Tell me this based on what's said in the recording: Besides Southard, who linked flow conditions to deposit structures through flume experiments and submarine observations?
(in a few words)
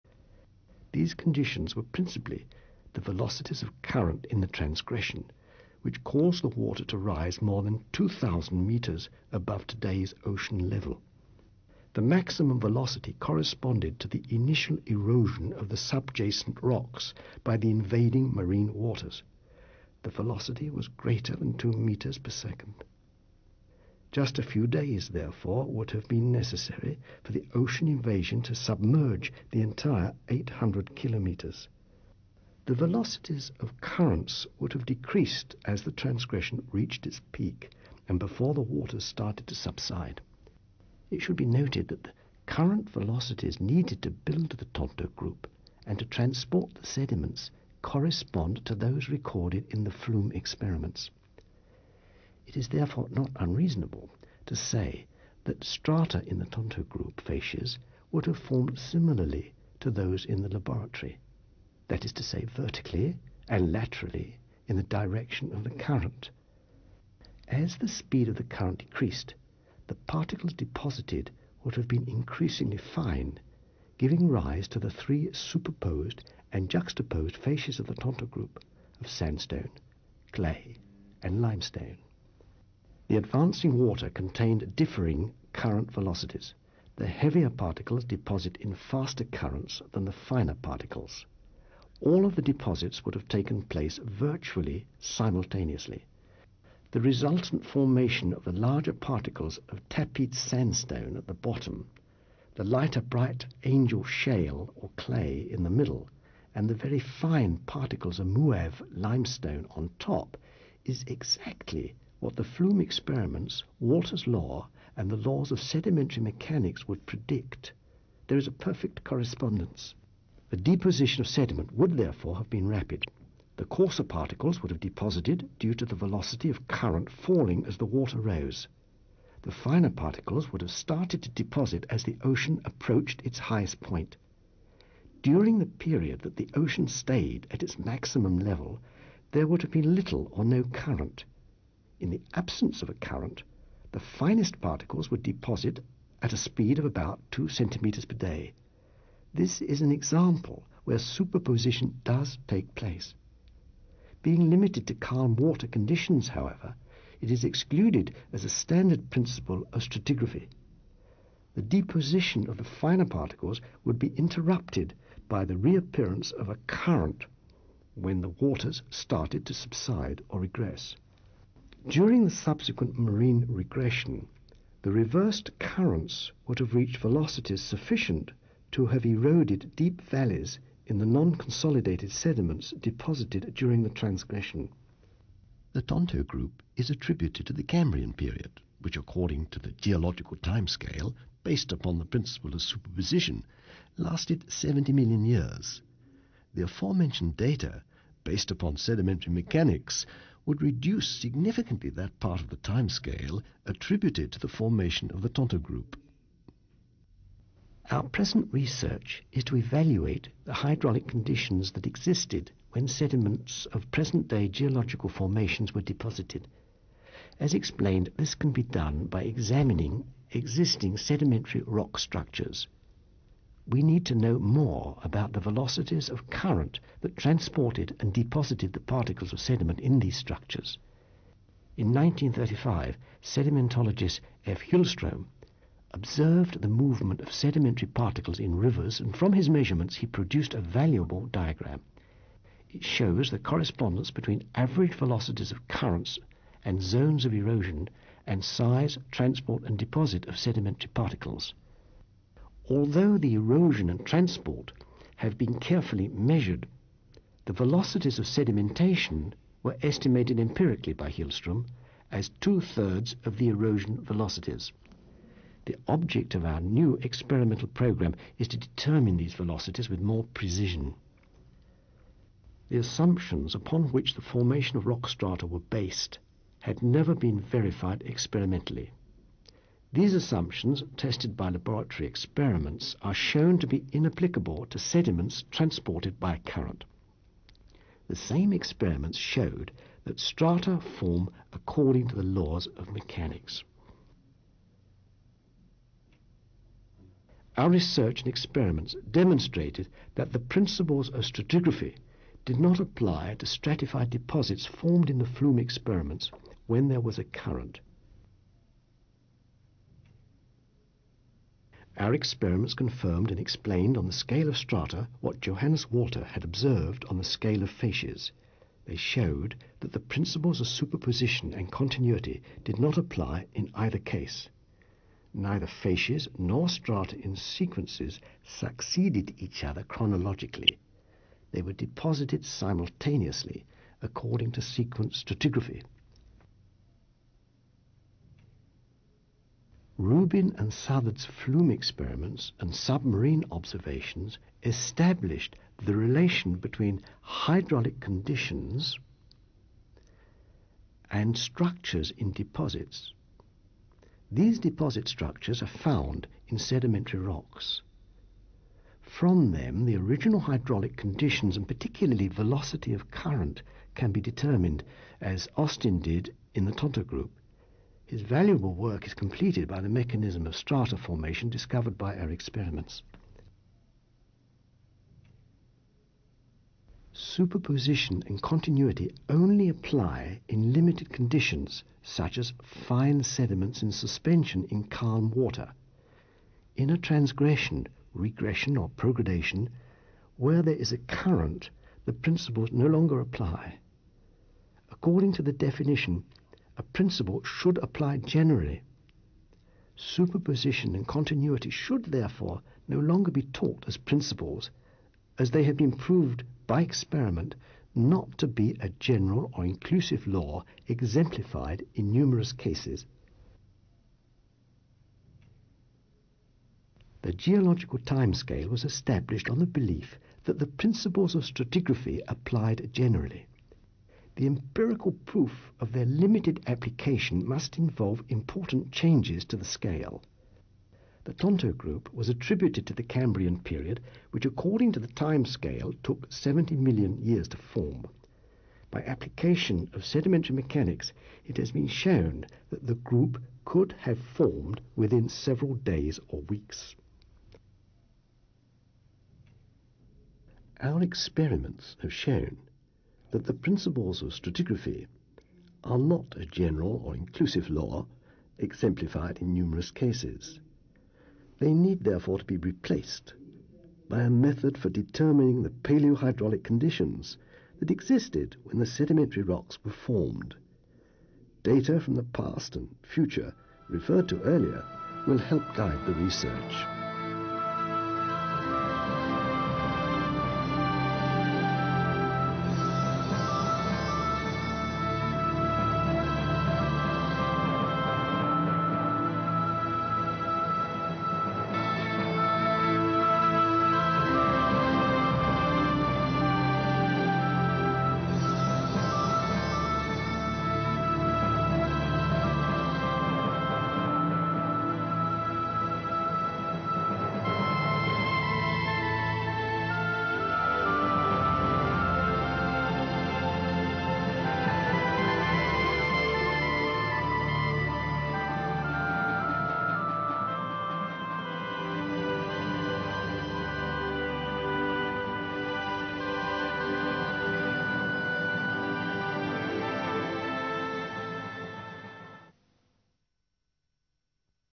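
Rubin.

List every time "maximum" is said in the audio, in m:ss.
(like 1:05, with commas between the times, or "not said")
0:12, 2:17.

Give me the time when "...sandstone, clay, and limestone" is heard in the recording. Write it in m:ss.
1:19.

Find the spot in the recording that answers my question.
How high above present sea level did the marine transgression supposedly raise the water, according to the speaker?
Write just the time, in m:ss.
0:07.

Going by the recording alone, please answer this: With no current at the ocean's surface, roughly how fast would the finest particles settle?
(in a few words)
2 centimeters per day.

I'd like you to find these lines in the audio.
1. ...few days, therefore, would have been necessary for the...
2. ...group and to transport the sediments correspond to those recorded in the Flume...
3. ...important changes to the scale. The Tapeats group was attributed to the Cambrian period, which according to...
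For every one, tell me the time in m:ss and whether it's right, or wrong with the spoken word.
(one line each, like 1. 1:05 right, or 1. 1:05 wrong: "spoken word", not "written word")
1. 0:24 right
2. 0:45 right
3. 7:08 wrong: "Tonto", not "Tapeats".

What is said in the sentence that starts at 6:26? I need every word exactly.
In a transgression, regression or progradation, where there is a current, the principles no longer apply.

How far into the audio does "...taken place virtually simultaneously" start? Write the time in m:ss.
1:33.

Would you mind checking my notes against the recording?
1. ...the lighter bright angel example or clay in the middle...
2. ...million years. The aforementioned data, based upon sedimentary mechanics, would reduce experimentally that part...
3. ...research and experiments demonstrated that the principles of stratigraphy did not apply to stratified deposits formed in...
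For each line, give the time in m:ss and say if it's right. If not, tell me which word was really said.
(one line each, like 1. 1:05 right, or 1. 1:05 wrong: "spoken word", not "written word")
1. 1:42 wrong: "shale", not "example"
2. 3:14 wrong: "significantly", not "experimentally"
3. 4:57 right.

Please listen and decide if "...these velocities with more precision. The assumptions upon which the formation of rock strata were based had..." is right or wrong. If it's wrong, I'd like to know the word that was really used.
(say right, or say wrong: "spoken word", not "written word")
right.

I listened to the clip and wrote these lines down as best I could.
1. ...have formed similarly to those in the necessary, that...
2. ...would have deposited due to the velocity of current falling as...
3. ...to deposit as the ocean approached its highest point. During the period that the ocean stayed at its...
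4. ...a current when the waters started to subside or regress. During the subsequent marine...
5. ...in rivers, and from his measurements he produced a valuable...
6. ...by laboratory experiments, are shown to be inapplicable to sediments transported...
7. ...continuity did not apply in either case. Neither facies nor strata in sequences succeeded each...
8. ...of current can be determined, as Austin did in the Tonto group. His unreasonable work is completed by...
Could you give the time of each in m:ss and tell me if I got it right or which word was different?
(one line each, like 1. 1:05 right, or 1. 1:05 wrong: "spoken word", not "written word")
1. 0:58 wrong: "laboratory", not "necessary"
2. 2:04 right
3. 2:11 right
4. 2:46 right
5. 3:58 right
6. 4:41 right
7. 5:21 right
8. 6:02 wrong: "valuable", not "unreasonable".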